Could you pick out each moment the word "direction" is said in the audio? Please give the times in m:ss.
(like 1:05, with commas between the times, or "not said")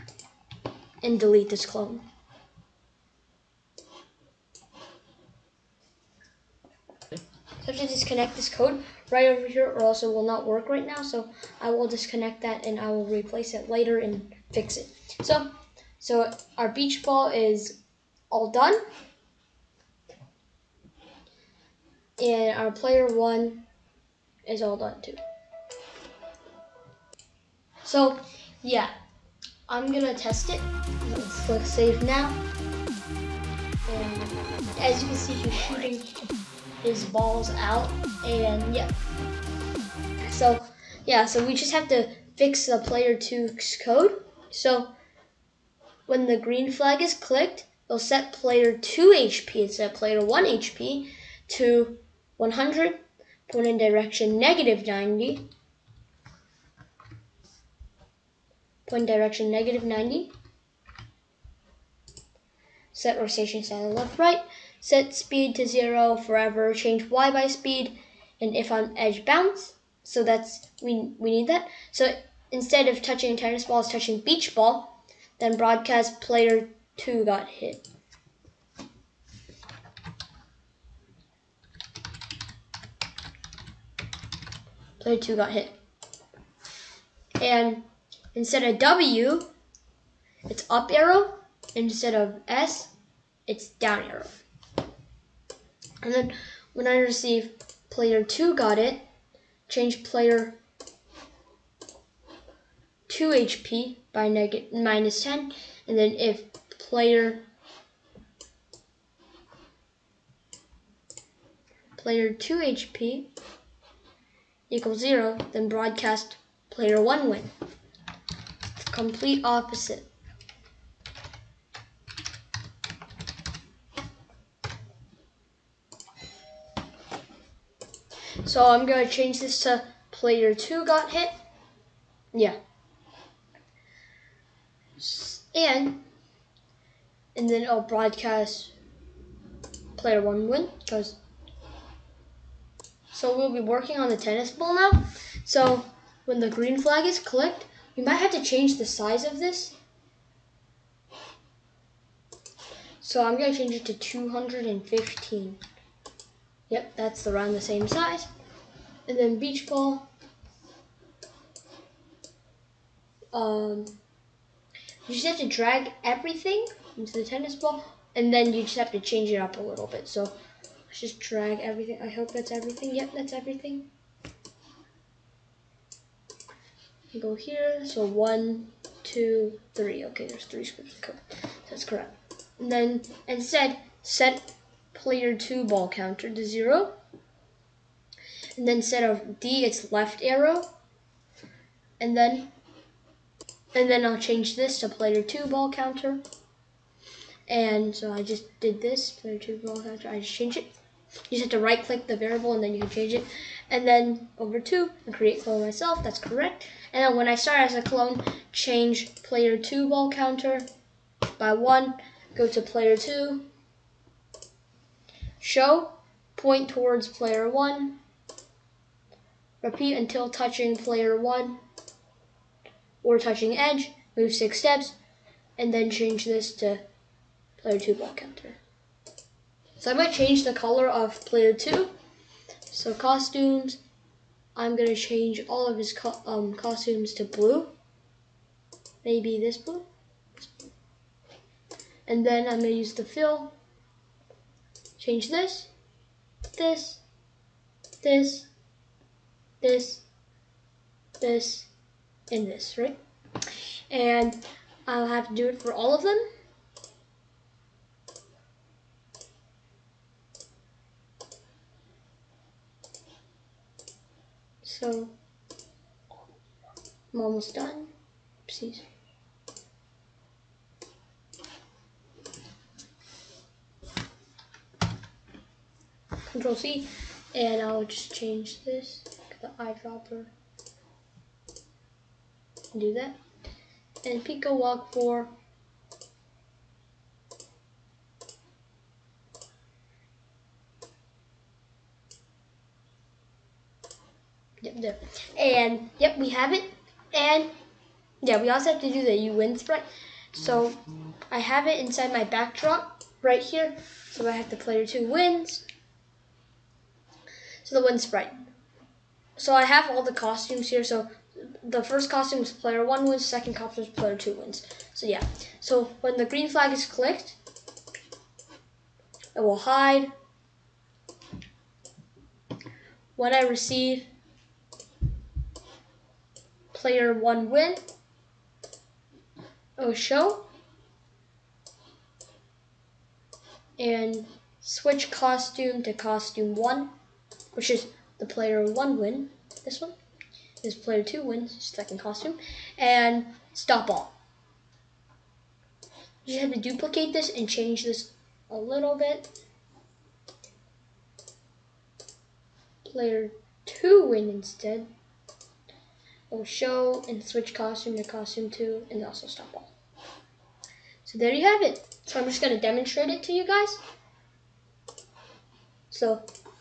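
0:53, 0:59.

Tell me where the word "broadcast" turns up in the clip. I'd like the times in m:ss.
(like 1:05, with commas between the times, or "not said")
1:15, 1:55, 2:17.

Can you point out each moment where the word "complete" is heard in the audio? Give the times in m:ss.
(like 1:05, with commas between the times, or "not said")
1:58.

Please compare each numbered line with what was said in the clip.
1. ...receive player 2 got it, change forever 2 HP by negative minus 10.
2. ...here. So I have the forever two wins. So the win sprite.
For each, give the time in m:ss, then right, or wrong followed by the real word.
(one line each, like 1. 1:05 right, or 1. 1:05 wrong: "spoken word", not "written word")
1. 1:36 wrong: "player", not "forever"
2. 5:03 wrong: "player", not "forever".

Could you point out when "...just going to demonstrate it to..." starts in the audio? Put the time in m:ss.
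6:02.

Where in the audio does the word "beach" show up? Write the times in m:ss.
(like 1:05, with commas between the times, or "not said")
0:16, 1:14, 2:39.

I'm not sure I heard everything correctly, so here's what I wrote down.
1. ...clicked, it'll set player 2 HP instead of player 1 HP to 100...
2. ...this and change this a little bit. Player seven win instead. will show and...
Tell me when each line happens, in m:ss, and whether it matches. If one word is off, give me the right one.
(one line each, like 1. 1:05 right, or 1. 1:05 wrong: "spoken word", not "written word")
1. 0:47 right
2. 5:47 wrong: "two", not "seven".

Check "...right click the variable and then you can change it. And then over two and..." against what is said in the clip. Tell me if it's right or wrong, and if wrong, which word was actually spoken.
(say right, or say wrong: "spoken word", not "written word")
right.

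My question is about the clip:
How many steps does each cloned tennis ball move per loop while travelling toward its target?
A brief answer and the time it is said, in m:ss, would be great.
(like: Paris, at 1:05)
6, at 3:44.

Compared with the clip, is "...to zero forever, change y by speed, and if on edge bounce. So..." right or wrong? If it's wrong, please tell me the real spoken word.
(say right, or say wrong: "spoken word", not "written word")
right.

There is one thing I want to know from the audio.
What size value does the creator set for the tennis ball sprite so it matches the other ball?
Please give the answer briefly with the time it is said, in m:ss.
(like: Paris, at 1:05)
215, at 2:33.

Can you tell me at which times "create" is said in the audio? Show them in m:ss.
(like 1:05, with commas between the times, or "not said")
3:25.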